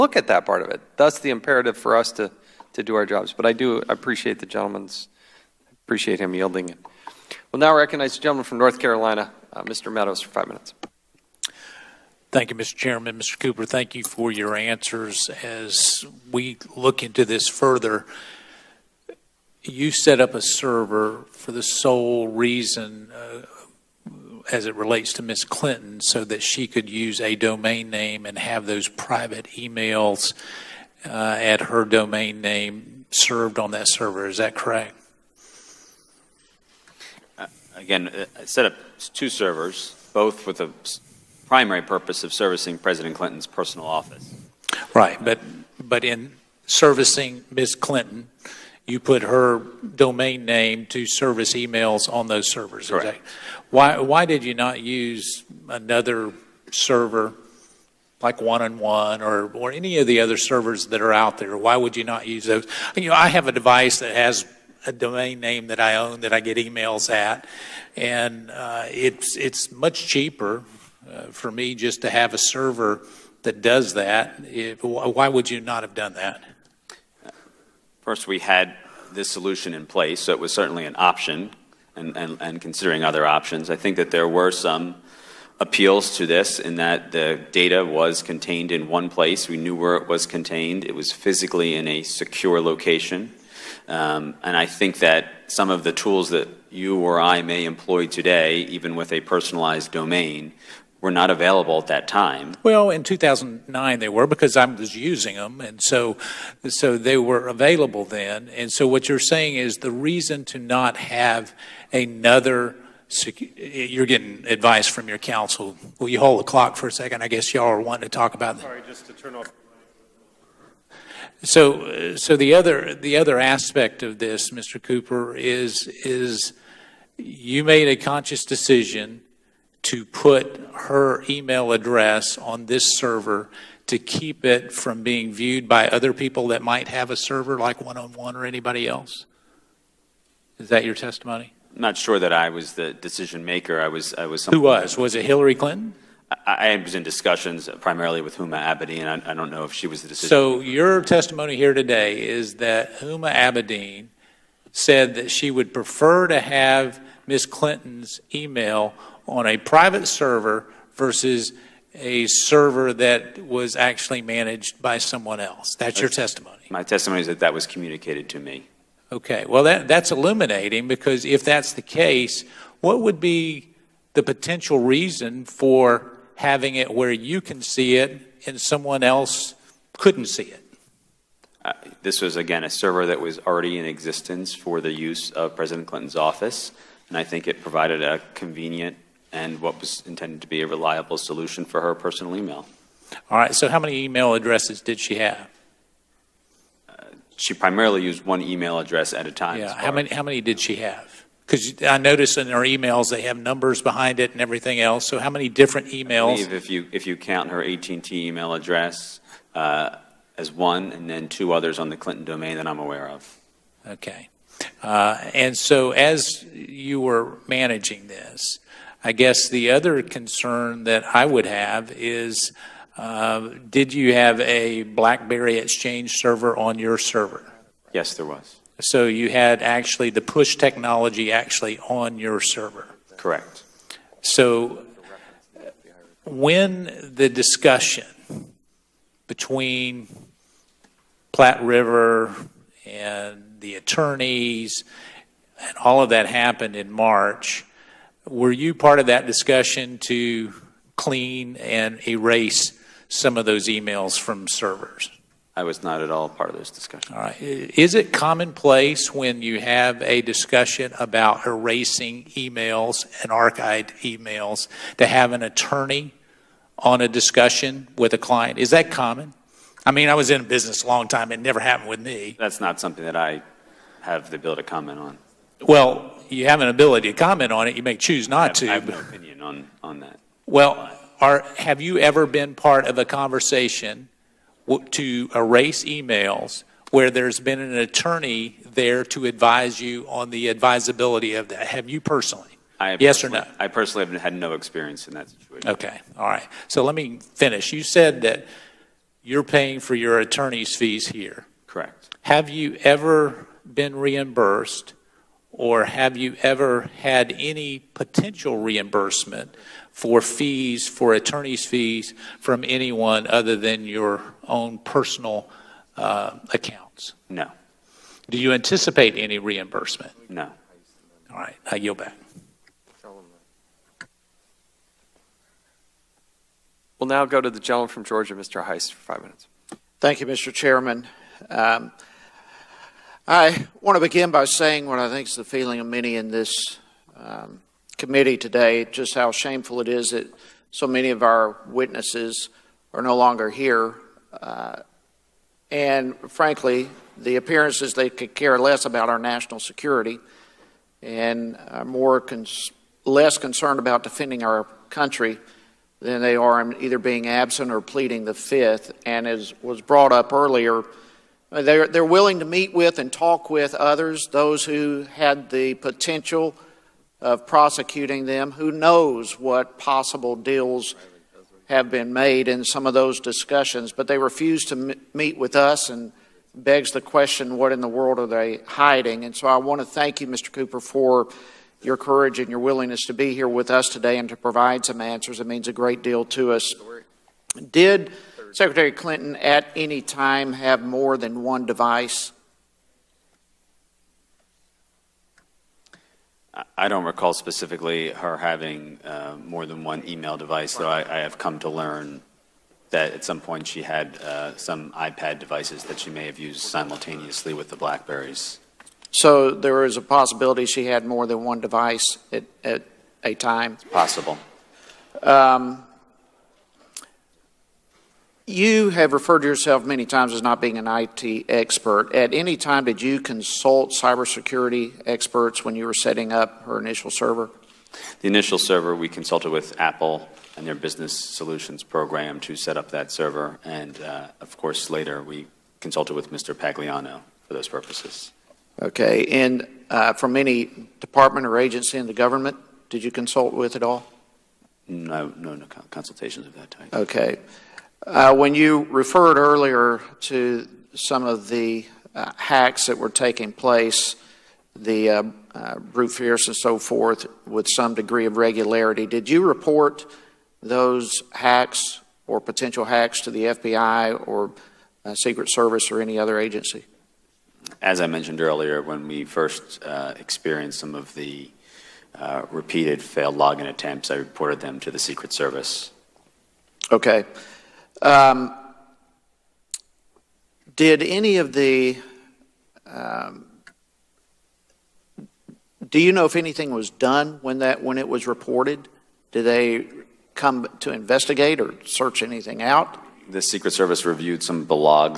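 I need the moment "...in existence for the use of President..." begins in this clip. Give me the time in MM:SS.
03:03.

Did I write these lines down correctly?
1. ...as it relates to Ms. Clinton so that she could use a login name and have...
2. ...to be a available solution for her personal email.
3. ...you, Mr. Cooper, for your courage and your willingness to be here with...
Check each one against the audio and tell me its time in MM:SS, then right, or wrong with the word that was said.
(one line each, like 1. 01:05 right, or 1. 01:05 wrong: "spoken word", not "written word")
1. 00:24 wrong: "domain", not "login"
2. 03:10 wrong: "reliable", not "available"
3. 06:20 right.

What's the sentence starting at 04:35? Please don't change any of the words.
Well, you have an ability to comment on it.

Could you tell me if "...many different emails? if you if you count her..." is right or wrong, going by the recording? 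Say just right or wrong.
right.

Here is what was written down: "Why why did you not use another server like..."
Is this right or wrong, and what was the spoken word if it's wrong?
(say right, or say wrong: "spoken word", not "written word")
right.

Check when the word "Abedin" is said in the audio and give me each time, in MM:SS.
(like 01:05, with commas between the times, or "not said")
02:28, 02:33.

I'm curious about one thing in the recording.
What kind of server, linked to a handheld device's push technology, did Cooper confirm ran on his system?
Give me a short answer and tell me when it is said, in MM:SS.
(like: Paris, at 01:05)
BlackBerry Exchange server, at 03:44.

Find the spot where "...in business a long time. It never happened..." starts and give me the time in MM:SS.
04:30.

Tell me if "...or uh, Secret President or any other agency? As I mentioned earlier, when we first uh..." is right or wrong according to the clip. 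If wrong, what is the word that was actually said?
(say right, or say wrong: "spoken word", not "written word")
wrong: "Service", not "President".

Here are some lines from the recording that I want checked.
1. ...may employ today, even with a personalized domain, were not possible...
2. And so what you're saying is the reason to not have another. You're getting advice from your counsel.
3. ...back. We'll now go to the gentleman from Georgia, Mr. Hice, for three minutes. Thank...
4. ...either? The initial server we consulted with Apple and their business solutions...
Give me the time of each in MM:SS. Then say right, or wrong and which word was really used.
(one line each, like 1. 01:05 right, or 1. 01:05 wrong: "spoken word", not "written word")
1. 01:37 wrong: "available", not "possible"
2. 01:48 right
3. 05:21 wrong: "five", not "three"
4. 07:07 wrong: "server", not "either".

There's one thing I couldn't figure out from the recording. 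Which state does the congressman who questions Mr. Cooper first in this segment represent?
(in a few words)
North Carolina.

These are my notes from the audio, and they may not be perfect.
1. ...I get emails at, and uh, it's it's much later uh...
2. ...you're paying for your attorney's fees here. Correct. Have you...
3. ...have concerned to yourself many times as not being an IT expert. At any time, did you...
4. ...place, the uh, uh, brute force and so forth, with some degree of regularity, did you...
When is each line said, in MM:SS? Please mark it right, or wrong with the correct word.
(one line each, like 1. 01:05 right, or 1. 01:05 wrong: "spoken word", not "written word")
1. 01:06 wrong: "cheaper", not "later"
2. 04:59 right
3. 06:58 wrong: "referred", not "concerned"
4. 07:33 right.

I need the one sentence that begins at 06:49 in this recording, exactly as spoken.
So there is a possibility she had more than one device at, at a time?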